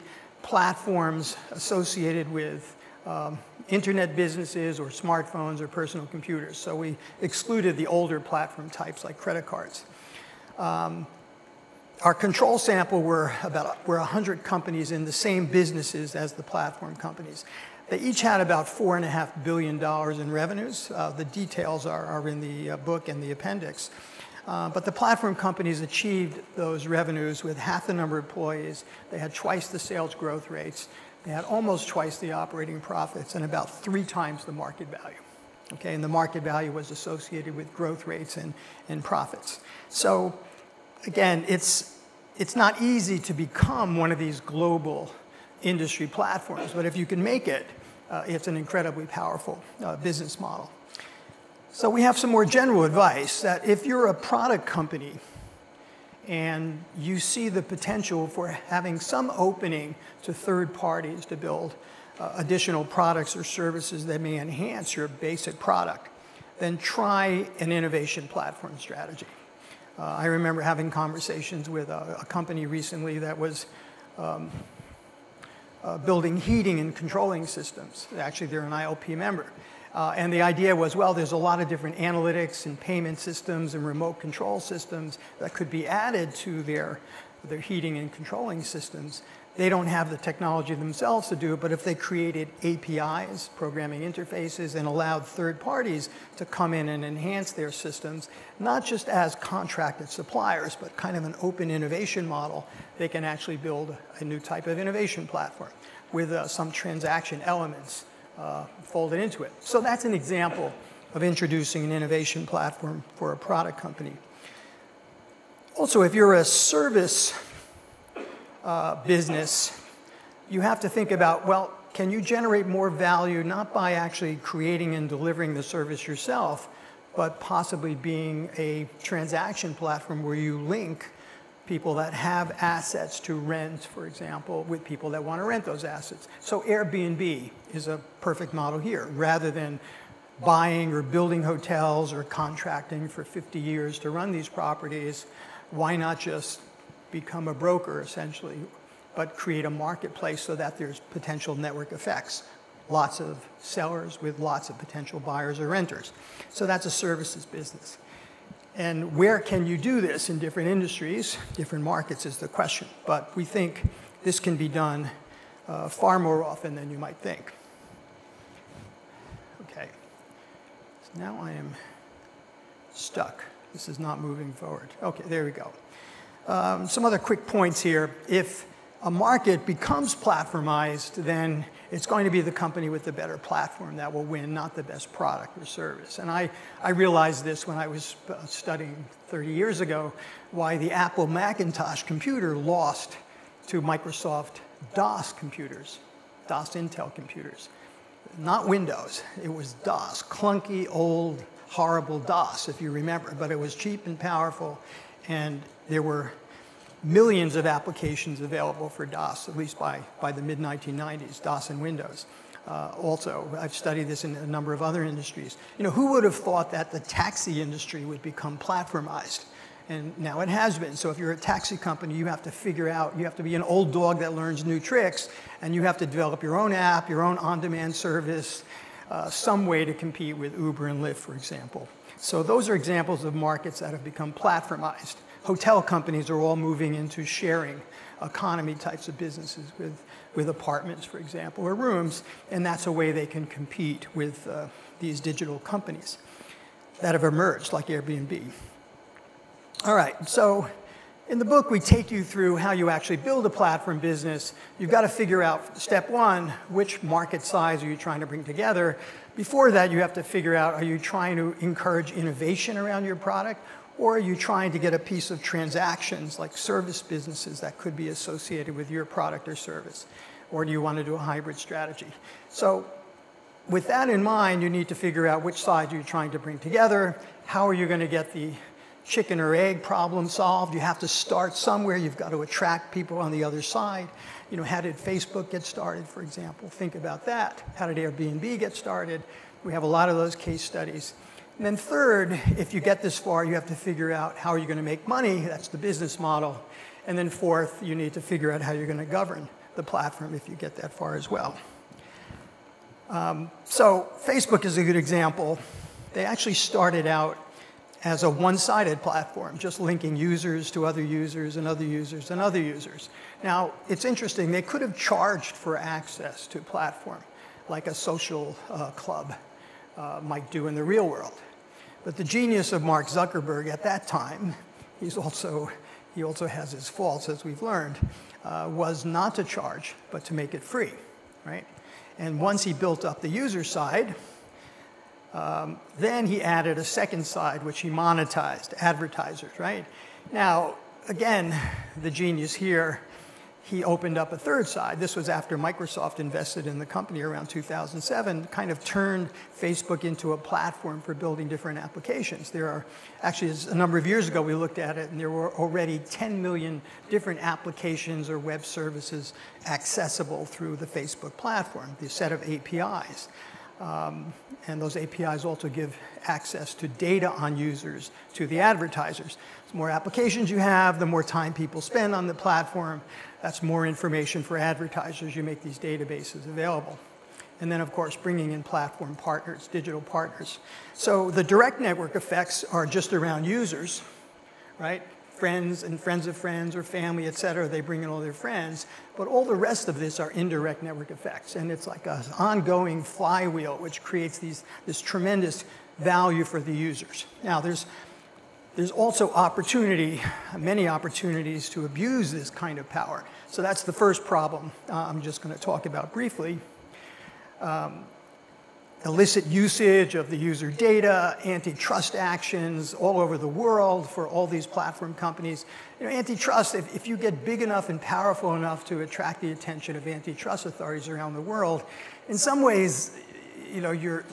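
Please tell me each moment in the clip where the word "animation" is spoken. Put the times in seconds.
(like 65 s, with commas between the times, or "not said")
not said.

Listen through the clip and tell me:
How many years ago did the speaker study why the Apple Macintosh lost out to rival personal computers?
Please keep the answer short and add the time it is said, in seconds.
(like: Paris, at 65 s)
30, at 189 s.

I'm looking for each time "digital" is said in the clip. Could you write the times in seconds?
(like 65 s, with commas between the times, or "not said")
245 s, 379 s.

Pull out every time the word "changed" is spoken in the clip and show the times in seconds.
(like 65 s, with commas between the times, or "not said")
not said.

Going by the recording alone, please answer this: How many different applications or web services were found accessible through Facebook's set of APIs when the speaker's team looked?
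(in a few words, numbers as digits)
10 million.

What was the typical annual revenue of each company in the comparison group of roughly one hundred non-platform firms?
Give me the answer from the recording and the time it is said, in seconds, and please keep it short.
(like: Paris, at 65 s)
$4.5 billion, at 18 s.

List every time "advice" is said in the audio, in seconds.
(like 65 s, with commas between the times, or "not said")
52 s.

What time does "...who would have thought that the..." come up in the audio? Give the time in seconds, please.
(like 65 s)
215 s.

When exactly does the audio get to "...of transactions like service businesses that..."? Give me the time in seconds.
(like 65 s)
265 s.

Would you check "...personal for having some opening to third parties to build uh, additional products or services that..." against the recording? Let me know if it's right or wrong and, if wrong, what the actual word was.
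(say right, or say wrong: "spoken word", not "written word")
wrong: "potential", not "personal".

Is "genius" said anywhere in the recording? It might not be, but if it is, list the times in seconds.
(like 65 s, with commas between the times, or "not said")
322 s, 342 s.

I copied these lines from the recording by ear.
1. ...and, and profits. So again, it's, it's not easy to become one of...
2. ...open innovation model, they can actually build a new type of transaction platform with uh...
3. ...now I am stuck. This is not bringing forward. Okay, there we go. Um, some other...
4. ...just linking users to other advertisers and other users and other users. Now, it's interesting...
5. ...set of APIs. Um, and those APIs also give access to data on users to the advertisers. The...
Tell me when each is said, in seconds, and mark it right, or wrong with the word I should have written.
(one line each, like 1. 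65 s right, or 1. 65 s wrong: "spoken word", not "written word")
1. 38 s right
2. 101 s wrong: "innovation", not "transaction"
3. 171 s wrong: "moving", not "bringing"
4. 309 s wrong: "users", not "advertisers"
5. 362 s right.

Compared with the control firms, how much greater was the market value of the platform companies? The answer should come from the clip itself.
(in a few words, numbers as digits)
about three times.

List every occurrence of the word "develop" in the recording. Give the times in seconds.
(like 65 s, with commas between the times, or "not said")
226 s.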